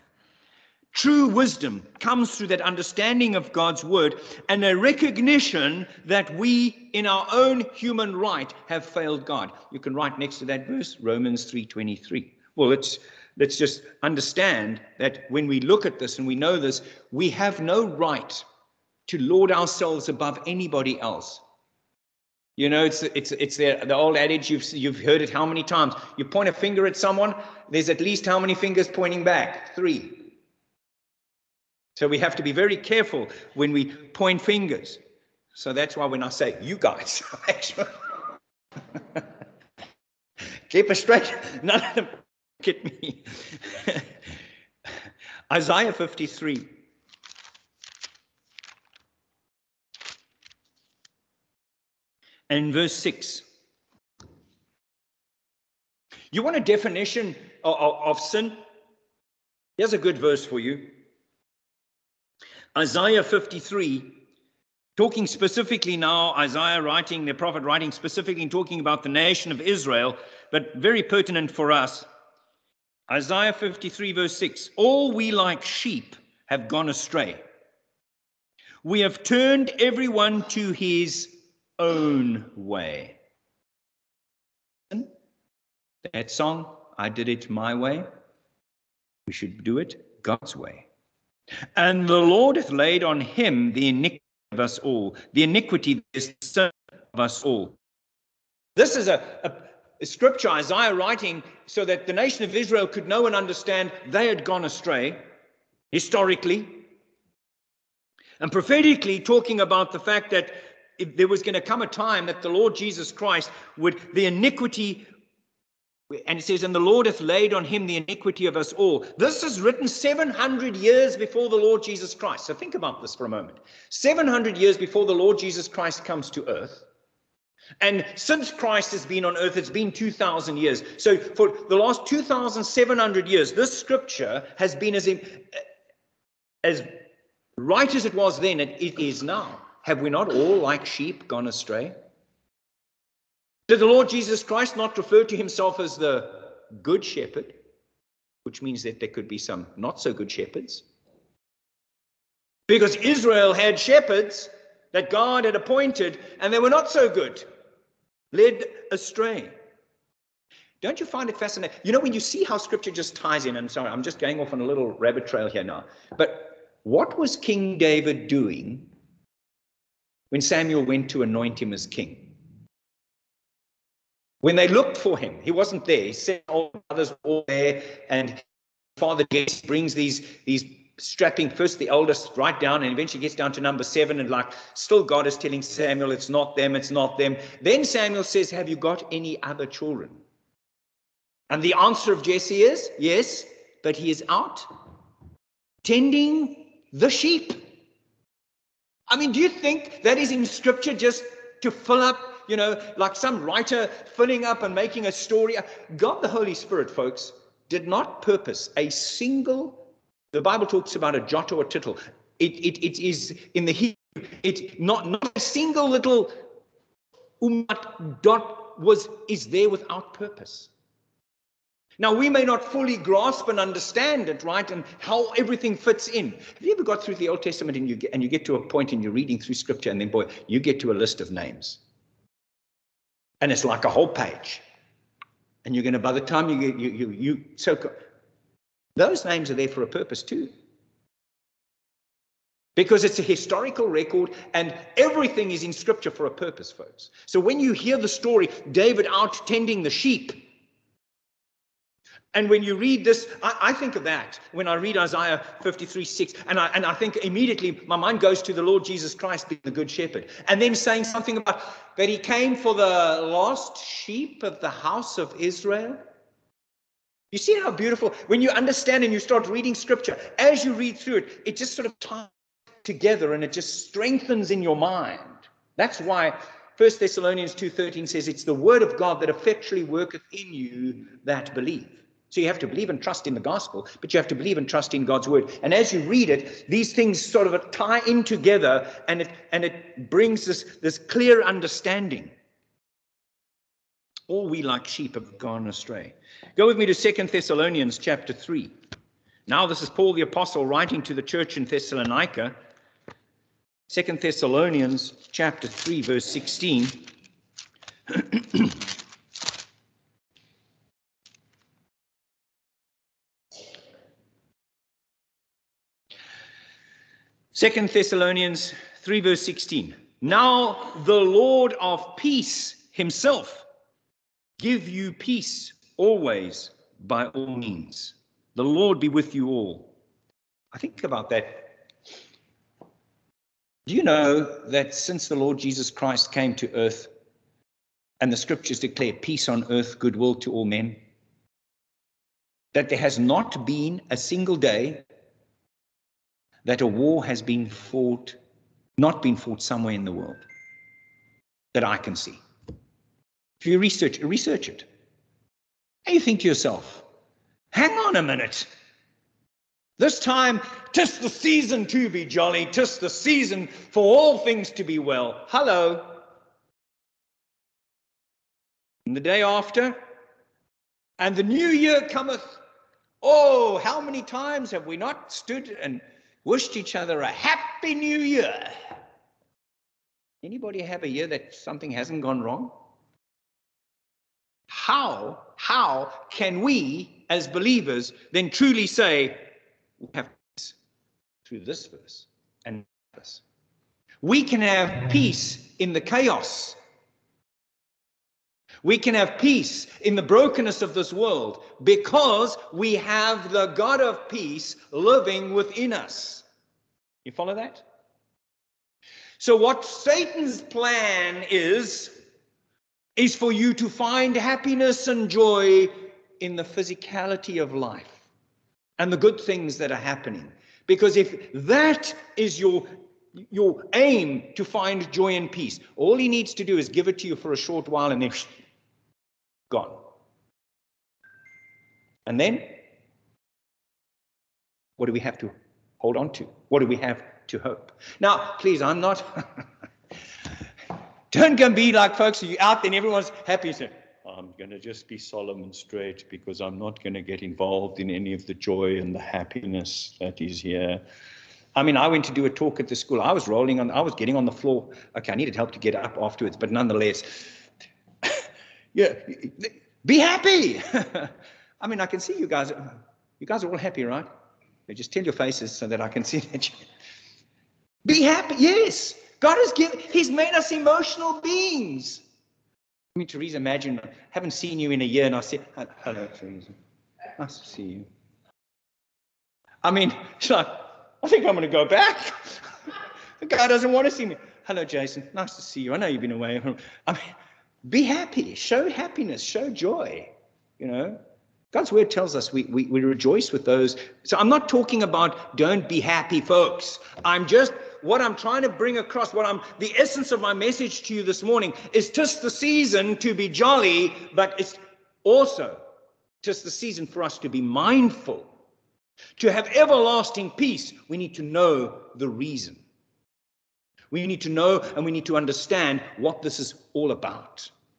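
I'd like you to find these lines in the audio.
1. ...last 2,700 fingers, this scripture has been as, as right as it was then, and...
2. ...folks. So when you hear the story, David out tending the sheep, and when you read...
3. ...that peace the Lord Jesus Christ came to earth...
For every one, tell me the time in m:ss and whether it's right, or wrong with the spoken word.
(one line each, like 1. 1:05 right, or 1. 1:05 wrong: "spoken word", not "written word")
1. 2:11 wrong: "years", not "fingers"
2. 4:06 right
3. 5:34 wrong: "since", not "peace".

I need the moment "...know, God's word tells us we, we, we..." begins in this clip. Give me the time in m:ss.
8:10.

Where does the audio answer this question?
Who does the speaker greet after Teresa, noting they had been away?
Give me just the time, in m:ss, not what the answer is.
8:04.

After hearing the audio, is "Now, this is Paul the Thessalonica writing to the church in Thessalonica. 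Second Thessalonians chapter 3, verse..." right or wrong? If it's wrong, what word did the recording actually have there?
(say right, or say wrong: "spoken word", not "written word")
wrong: "Apostle", not "Thessalonica".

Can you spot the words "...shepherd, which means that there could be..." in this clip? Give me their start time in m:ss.
2:27.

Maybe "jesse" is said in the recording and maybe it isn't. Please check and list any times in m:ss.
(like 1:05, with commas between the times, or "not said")
2:59, 3:12.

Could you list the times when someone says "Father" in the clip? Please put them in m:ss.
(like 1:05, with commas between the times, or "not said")
2:58.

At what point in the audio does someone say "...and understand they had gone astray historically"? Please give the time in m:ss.
1:43.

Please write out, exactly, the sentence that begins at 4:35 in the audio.
That's why 1 Thessalonians 2.13 says it's the word of God that effectually worketh in you that believe.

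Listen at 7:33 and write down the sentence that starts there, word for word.
I was rolling on, I was getting on the floor.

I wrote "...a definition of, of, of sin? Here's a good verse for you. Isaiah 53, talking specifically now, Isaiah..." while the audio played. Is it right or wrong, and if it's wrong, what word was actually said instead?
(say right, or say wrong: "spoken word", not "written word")
right.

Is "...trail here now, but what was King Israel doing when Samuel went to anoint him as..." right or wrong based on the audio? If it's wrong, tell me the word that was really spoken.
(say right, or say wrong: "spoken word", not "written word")
wrong: "David", not "Israel".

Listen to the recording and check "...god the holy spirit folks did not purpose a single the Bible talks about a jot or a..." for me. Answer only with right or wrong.
right.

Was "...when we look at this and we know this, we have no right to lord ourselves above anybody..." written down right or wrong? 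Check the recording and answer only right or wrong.
right.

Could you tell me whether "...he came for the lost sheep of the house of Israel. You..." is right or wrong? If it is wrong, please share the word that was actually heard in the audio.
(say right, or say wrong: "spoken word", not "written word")
right.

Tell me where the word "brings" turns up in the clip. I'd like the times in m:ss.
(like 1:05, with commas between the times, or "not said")
2:59, 4:50, 8:18.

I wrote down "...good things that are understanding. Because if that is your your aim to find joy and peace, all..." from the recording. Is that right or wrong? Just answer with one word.
wrong.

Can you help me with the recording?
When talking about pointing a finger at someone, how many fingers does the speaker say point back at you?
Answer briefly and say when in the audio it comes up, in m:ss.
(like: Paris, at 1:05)
3, at 0:29.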